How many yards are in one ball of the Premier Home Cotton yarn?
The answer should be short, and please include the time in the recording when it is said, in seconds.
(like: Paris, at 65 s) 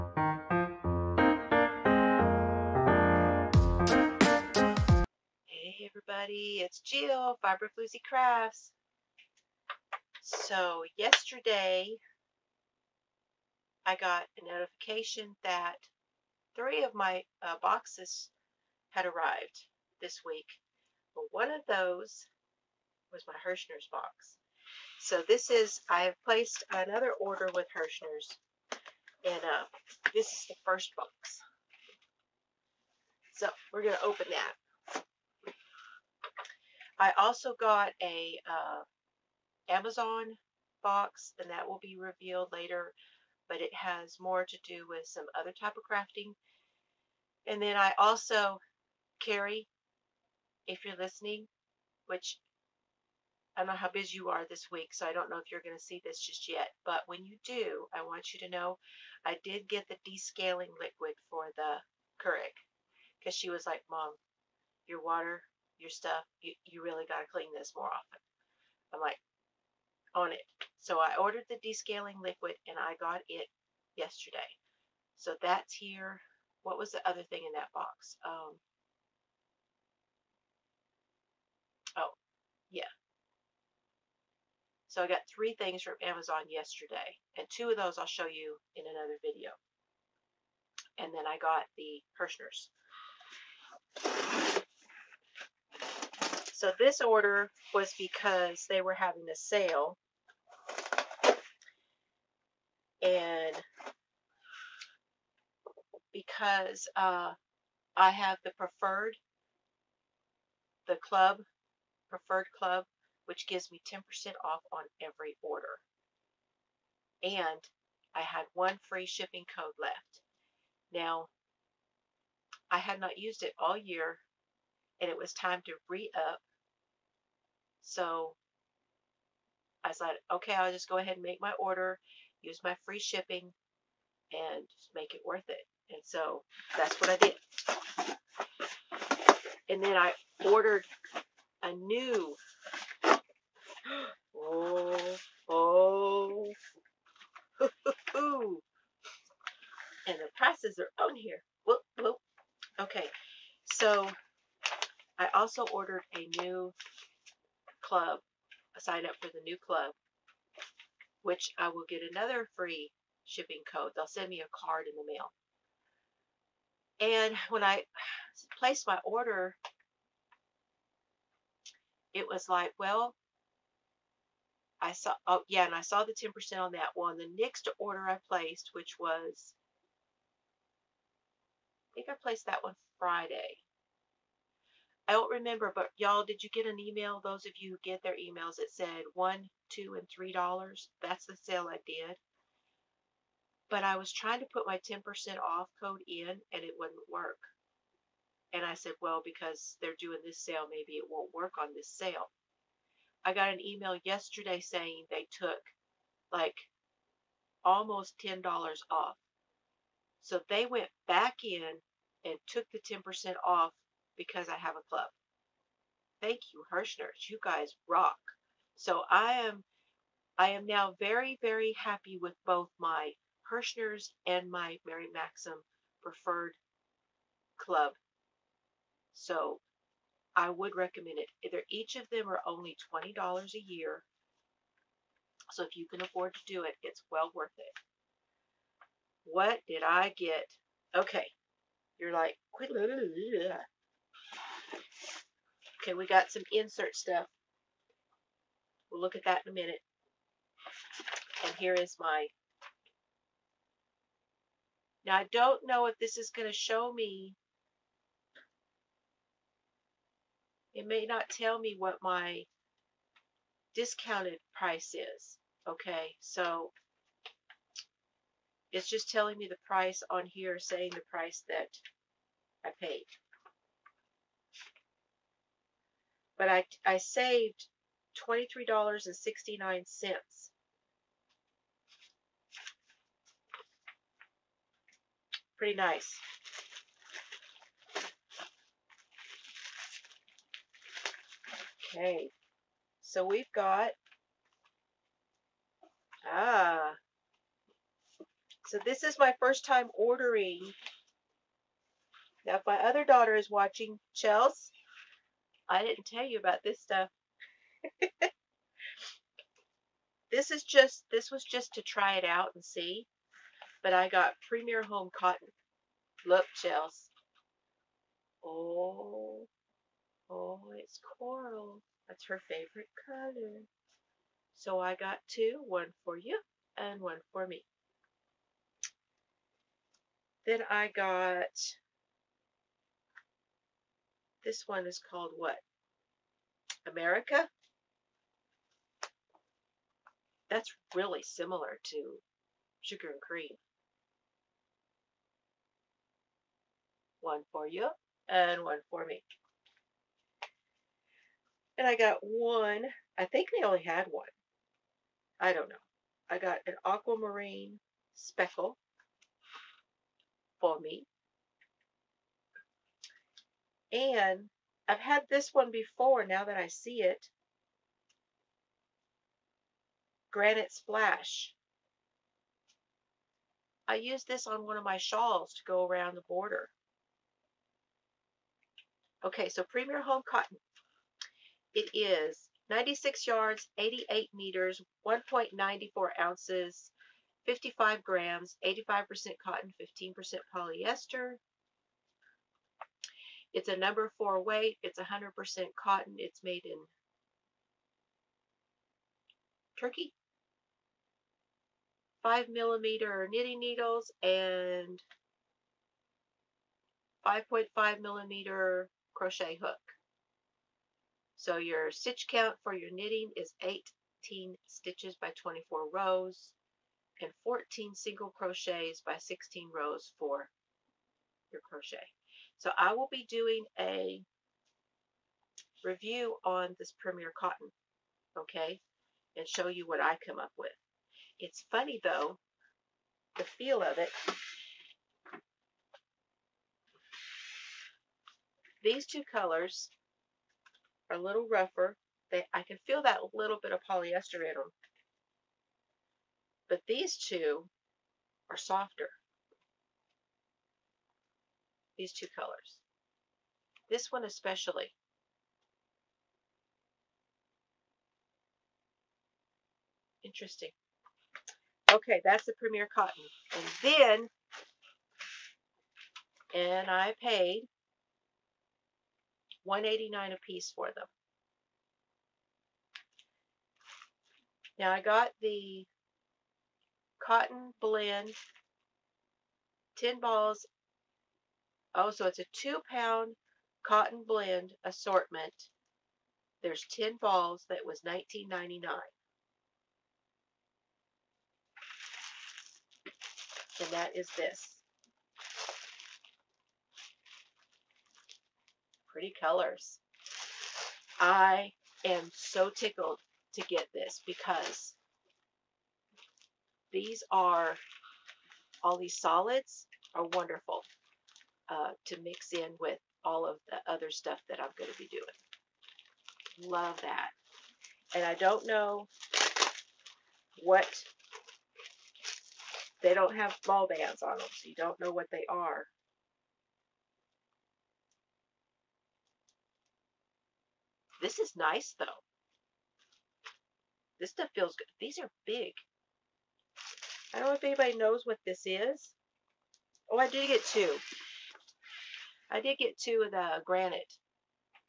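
96, at 382 s.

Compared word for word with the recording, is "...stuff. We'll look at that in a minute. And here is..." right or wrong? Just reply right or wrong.
right.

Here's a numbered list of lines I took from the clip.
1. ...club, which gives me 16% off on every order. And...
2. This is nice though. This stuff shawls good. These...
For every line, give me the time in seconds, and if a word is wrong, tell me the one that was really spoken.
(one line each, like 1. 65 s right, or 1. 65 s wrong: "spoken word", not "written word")
1. 112 s wrong: "10", not "16"
2. 531 s wrong: "feels", not "shawls".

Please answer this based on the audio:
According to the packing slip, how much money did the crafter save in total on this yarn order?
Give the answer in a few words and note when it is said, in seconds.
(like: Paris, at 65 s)
$23.69, at 278 s.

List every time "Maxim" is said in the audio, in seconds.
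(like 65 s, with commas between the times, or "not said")
225 s.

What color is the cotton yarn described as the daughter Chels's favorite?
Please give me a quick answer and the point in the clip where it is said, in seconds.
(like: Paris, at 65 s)
coral, at 321 s.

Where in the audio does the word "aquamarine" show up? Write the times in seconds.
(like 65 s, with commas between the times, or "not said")
356 s.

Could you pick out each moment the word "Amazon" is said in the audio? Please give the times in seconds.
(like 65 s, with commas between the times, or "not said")
39 s, 86 s.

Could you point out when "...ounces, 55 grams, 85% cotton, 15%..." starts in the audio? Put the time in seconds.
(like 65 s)
386 s.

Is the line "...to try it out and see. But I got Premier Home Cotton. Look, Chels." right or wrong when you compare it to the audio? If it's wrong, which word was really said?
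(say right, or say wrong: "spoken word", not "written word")
right.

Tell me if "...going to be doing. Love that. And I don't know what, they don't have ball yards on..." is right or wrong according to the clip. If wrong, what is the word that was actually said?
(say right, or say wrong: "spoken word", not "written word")
wrong: "bands", not "yards".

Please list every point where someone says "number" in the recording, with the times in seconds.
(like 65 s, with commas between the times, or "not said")
393 s.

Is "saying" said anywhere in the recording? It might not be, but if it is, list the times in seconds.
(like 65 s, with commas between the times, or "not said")
204 s, 270 s.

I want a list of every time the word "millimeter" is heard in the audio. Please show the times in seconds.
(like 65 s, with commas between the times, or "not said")
402 s, 408 s.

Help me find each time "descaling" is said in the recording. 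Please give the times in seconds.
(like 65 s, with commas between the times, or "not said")
60 s, 71 s.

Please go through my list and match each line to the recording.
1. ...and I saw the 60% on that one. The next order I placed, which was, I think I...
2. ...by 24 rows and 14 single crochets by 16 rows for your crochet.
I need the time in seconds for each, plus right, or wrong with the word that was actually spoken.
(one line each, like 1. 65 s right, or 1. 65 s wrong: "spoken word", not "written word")
1. 175 s wrong: "10", not "60"
2. 415 s right.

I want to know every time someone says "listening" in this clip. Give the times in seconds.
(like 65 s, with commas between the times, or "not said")
50 s.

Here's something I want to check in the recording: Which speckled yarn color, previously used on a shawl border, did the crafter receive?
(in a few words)
Granite Splash.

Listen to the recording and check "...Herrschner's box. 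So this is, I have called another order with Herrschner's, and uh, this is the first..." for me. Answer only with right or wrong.
wrong.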